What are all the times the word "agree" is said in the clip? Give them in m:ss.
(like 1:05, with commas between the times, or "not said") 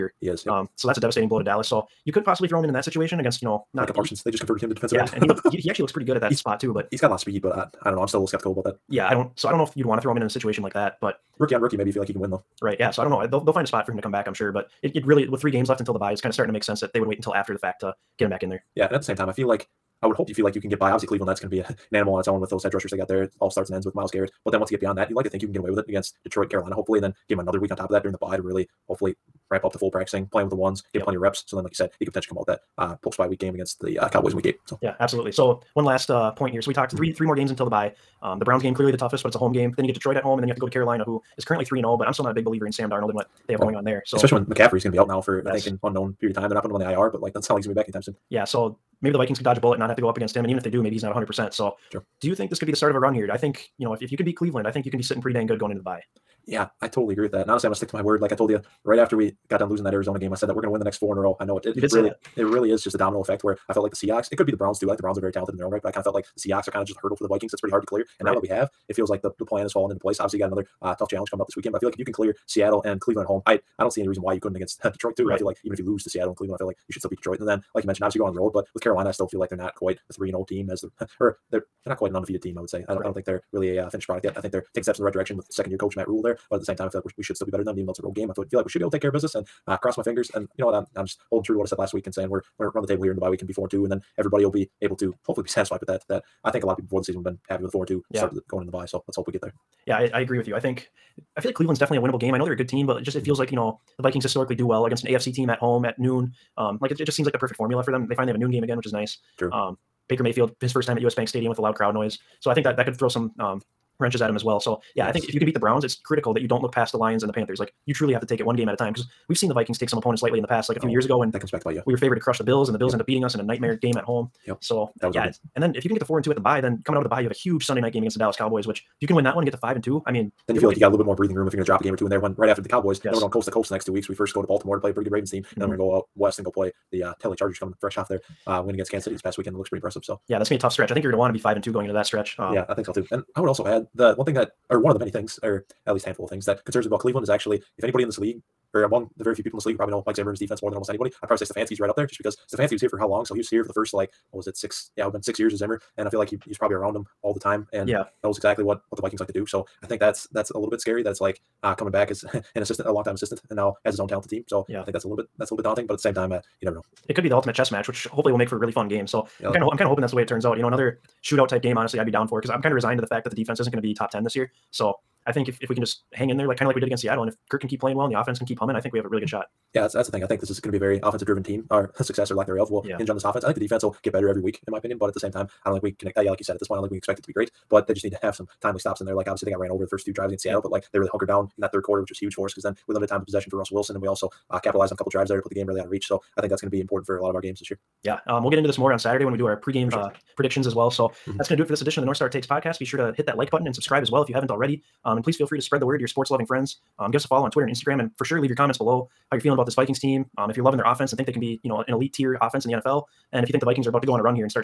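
0:57, 1:40.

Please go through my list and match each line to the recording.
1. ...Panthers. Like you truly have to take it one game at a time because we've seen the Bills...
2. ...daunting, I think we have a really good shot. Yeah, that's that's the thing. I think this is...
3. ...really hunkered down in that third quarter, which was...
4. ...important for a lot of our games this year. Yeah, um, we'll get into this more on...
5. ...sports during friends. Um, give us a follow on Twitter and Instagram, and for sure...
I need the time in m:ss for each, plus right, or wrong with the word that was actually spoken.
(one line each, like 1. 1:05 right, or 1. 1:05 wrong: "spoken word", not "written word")
1. 1:57 wrong: "Vikings", not "Bills"
2. 2:58 wrong: "humming", not "daunting"
3. 3:10 right
4. 3:16 right
5. 3:26 wrong: "loving", not "during".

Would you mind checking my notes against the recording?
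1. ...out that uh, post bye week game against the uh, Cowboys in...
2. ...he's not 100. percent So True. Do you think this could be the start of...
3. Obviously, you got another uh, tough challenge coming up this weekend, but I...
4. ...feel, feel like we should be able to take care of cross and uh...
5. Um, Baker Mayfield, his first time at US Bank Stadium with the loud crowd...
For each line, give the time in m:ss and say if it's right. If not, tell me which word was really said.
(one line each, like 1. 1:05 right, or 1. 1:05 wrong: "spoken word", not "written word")
1. 0:32 right
2. 0:50 right
3. 1:10 right
4. 1:28 wrong: "business", not "cross"
5. 1:49 right.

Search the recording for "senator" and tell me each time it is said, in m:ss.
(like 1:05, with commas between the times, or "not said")
not said.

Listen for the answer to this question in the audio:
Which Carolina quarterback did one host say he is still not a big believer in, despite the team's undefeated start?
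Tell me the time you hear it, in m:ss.
0:42.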